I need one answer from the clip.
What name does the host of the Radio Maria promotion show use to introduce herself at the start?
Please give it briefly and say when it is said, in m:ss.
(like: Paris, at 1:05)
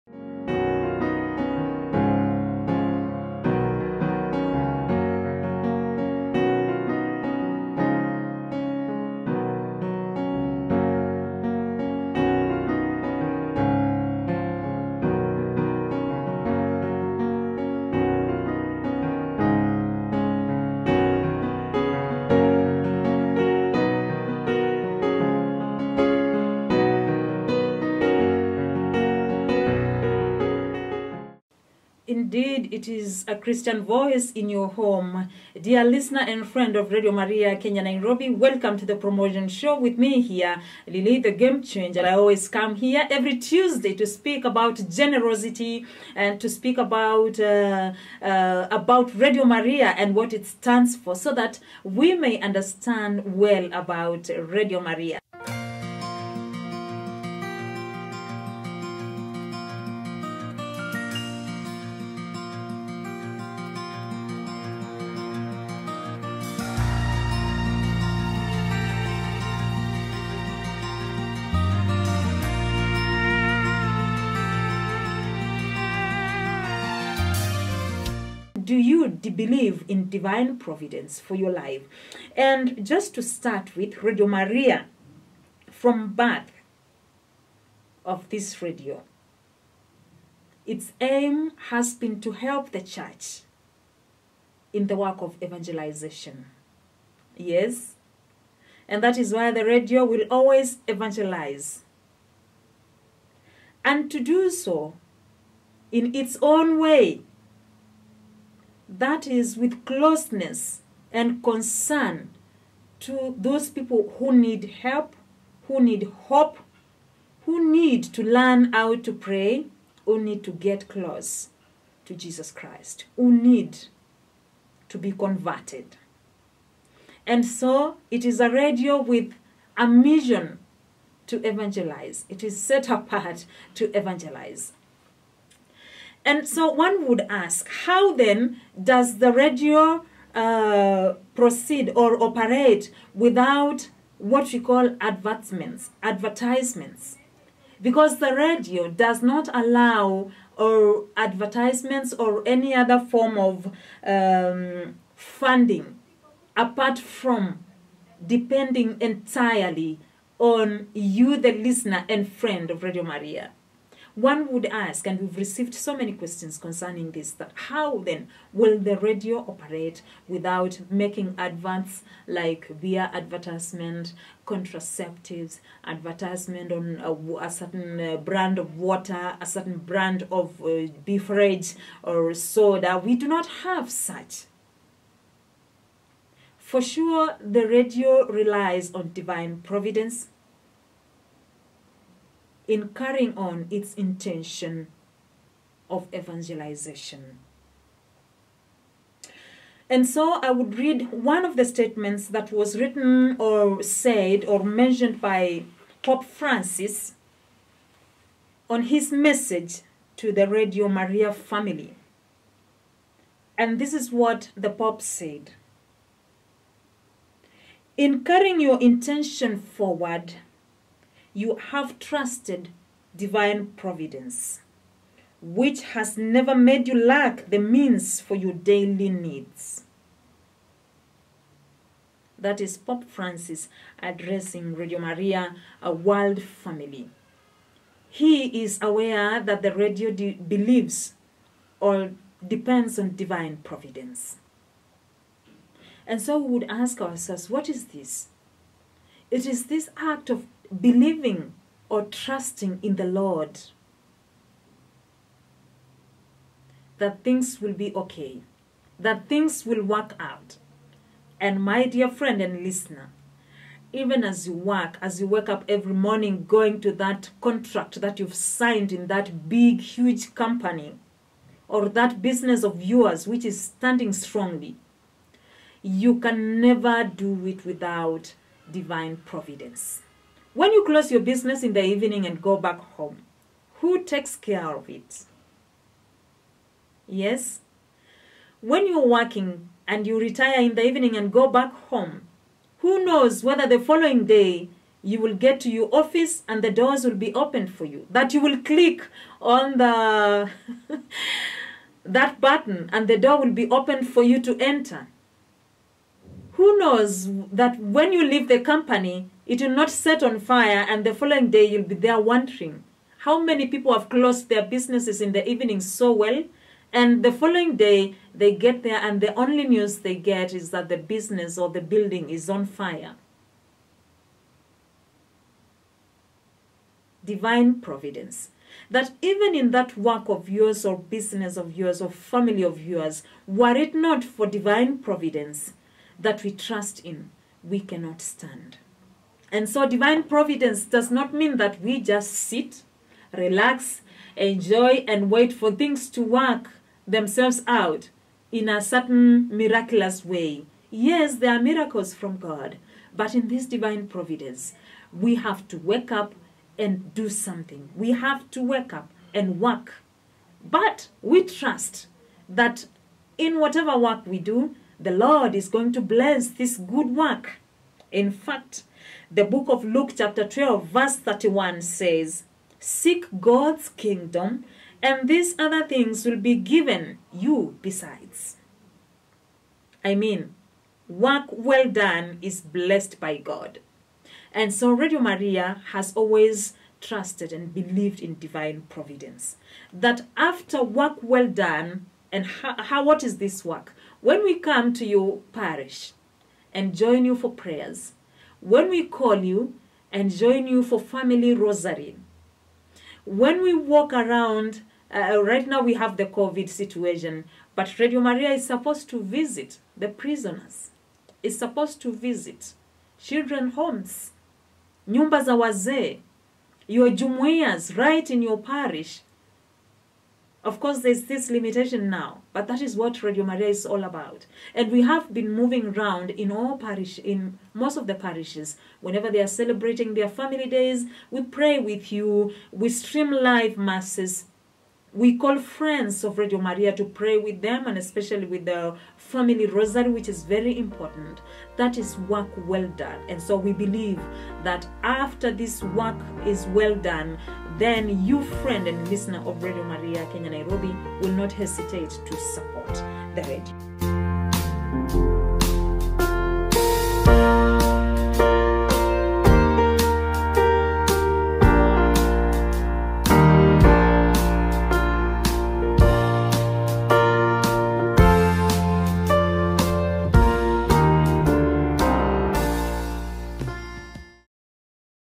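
Lilly the Game Changer, at 0:40.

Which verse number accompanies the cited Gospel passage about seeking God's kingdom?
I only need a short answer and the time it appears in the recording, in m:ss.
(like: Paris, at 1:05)
31, at 6:11.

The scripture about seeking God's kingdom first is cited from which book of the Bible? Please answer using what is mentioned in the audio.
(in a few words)
Luke.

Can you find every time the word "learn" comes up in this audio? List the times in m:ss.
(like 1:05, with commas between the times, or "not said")
1:58.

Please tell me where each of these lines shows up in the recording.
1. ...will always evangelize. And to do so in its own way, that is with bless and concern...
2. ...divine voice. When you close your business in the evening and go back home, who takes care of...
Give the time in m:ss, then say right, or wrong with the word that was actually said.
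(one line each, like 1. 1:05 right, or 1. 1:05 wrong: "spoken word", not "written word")
1. 1:40 wrong: "closeness", not "bless"
2. 4:38 wrong: "providence", not "voice".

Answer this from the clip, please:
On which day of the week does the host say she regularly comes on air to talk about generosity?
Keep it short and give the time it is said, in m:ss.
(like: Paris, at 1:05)
Tuesday, at 0:43.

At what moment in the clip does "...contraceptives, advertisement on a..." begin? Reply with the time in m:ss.
2:54.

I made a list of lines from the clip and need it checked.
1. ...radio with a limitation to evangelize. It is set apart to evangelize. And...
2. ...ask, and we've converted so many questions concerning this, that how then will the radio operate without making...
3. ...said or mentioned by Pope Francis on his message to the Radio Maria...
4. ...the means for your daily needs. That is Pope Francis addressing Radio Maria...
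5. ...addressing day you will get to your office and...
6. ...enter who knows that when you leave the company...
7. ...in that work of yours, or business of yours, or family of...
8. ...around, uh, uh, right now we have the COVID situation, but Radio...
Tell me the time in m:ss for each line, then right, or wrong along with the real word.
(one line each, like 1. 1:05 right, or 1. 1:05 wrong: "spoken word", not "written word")
1. 2:08 wrong: "mission", not "limitation"
2. 2:44 wrong: "received", not "converted"
3. 3:23 right
4. 3:47 right
5. 4:53 wrong: "following", not "addressing"
6. 5:04 right
7. 5:29 right
8. 6:44 right.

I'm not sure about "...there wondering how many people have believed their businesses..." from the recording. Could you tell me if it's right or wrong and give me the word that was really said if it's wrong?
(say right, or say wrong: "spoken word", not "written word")
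wrong: "closed", not "believed".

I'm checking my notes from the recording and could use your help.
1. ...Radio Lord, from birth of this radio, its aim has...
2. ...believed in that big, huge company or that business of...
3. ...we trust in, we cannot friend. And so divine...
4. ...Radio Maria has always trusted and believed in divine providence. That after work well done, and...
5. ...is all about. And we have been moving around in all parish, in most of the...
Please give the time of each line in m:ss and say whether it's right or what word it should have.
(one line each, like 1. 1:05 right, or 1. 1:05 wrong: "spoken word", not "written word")
1. 1:24 wrong: "Maria", not "Lord"
2. 4:28 wrong: "signed", not "believed"
3. 5:36 wrong: "stand", not "friend"
4. 6:24 right
5. 7:03 right.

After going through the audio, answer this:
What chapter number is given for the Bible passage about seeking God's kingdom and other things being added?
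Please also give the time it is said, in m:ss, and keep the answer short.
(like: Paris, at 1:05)
12, at 6:10.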